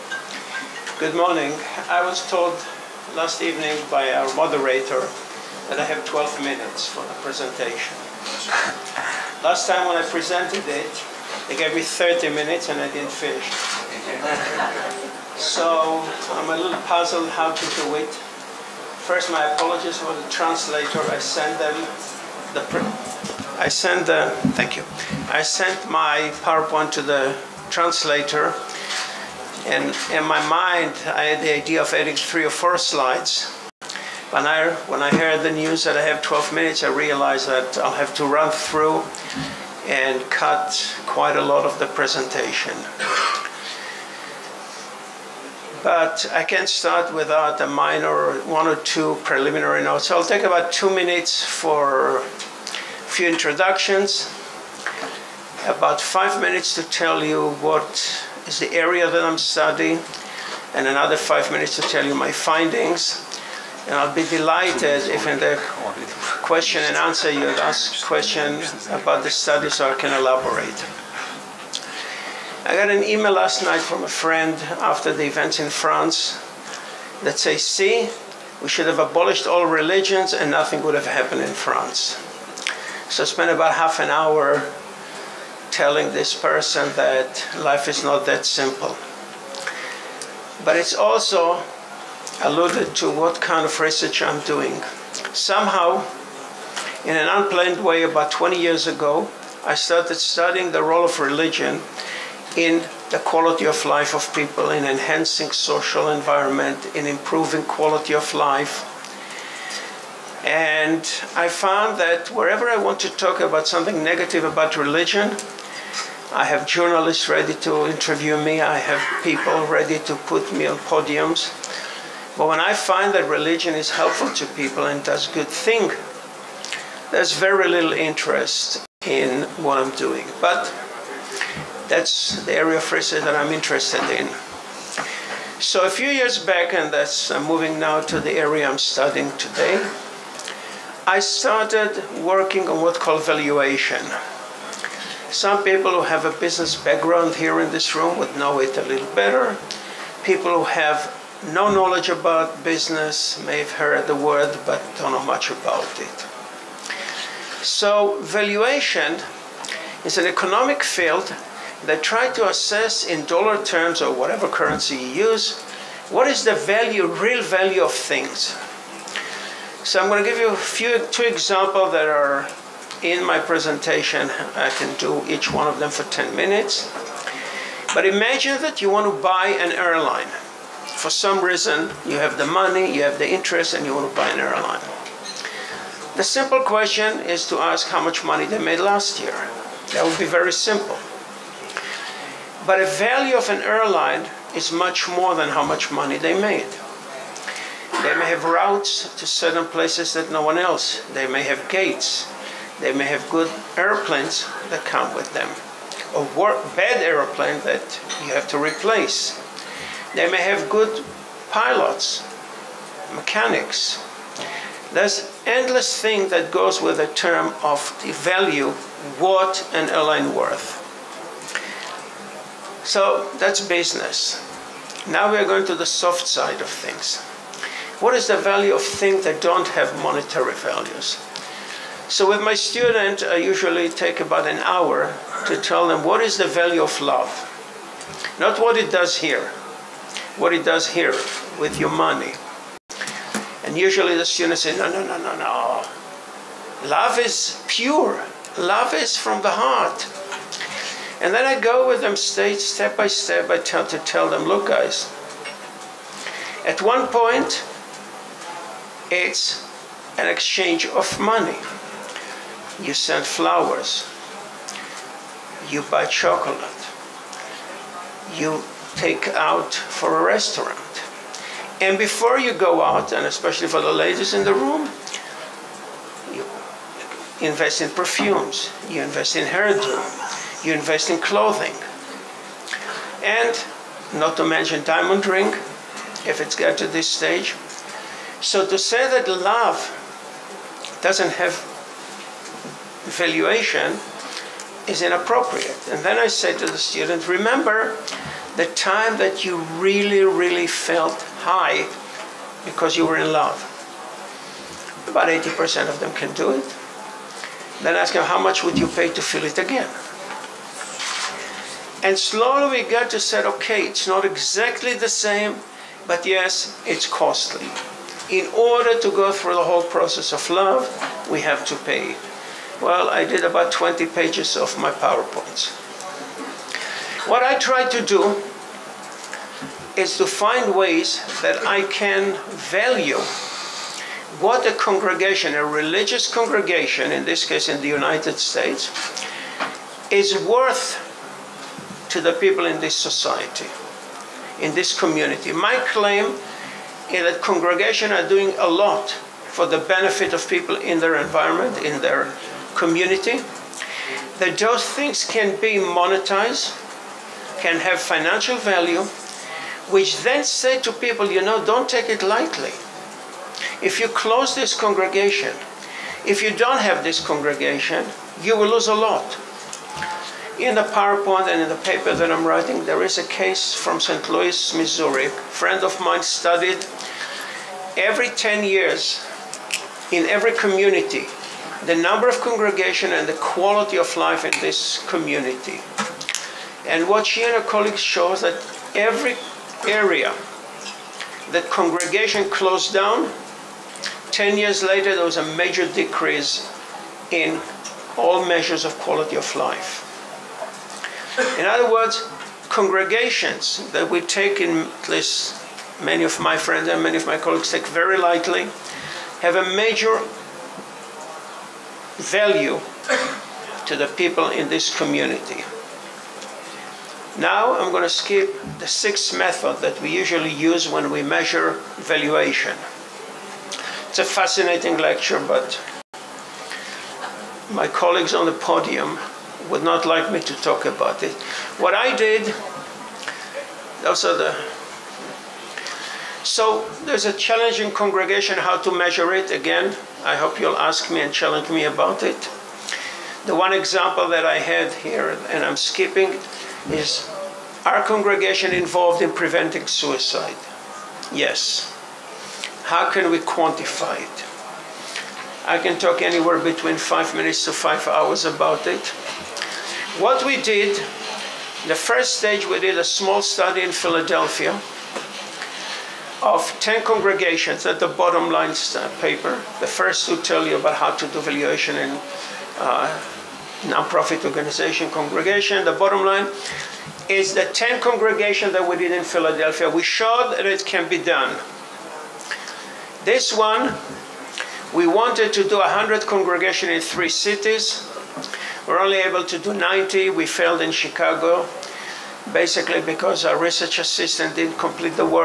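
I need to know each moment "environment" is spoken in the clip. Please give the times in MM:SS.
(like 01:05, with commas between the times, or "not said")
01:46, 05:51.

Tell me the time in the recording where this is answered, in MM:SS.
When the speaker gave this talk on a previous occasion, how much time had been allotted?
00:11.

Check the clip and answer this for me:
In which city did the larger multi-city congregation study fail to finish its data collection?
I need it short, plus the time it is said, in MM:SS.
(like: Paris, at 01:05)
Chicago, at 08:10.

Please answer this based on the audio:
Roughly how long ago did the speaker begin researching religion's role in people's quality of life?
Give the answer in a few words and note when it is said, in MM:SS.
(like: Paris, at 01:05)
About 20 years ago, at 01:38.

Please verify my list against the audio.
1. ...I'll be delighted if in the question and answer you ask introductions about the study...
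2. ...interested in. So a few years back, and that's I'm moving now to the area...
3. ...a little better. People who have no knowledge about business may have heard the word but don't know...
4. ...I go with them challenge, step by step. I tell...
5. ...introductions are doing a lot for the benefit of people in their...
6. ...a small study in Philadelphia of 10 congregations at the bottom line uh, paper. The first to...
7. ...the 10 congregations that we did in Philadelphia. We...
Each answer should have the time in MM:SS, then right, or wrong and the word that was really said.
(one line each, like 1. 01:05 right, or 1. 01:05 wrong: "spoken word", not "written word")
1. 01:03 wrong: "questions", not "introductions"
2. 02:13 right
3. 02:28 right
4. 04:11 wrong: "stage", not "challenge"
5. 05:47 wrong: "congregations", not "introductions"
6. 07:42 right
7. 07:57 right.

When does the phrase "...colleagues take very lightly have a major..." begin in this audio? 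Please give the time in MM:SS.
06:47.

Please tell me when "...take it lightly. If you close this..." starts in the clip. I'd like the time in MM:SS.
06:01.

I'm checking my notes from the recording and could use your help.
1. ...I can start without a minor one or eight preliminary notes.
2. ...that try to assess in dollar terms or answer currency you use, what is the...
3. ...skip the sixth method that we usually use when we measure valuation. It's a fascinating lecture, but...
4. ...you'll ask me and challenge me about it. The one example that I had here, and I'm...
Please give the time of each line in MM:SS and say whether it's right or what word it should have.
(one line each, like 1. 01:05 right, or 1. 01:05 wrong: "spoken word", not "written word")
1. 00:46 wrong: "two", not "eight"
2. 02:41 wrong: "whatever", not "answer"
3. 06:58 right
4. 07:20 right.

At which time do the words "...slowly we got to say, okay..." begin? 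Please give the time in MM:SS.
05:12.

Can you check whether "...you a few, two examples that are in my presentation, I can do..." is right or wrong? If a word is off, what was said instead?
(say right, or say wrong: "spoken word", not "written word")
right.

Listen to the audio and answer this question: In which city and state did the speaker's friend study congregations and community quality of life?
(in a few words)
St. Louis, Missouri.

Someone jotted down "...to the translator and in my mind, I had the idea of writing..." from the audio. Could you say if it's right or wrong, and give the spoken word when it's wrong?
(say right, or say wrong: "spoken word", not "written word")
wrong: "adding", not "writing".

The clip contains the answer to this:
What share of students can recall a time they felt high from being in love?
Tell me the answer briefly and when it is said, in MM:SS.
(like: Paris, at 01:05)
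About 80%, at 05:05.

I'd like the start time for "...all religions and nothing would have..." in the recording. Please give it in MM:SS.
01:19.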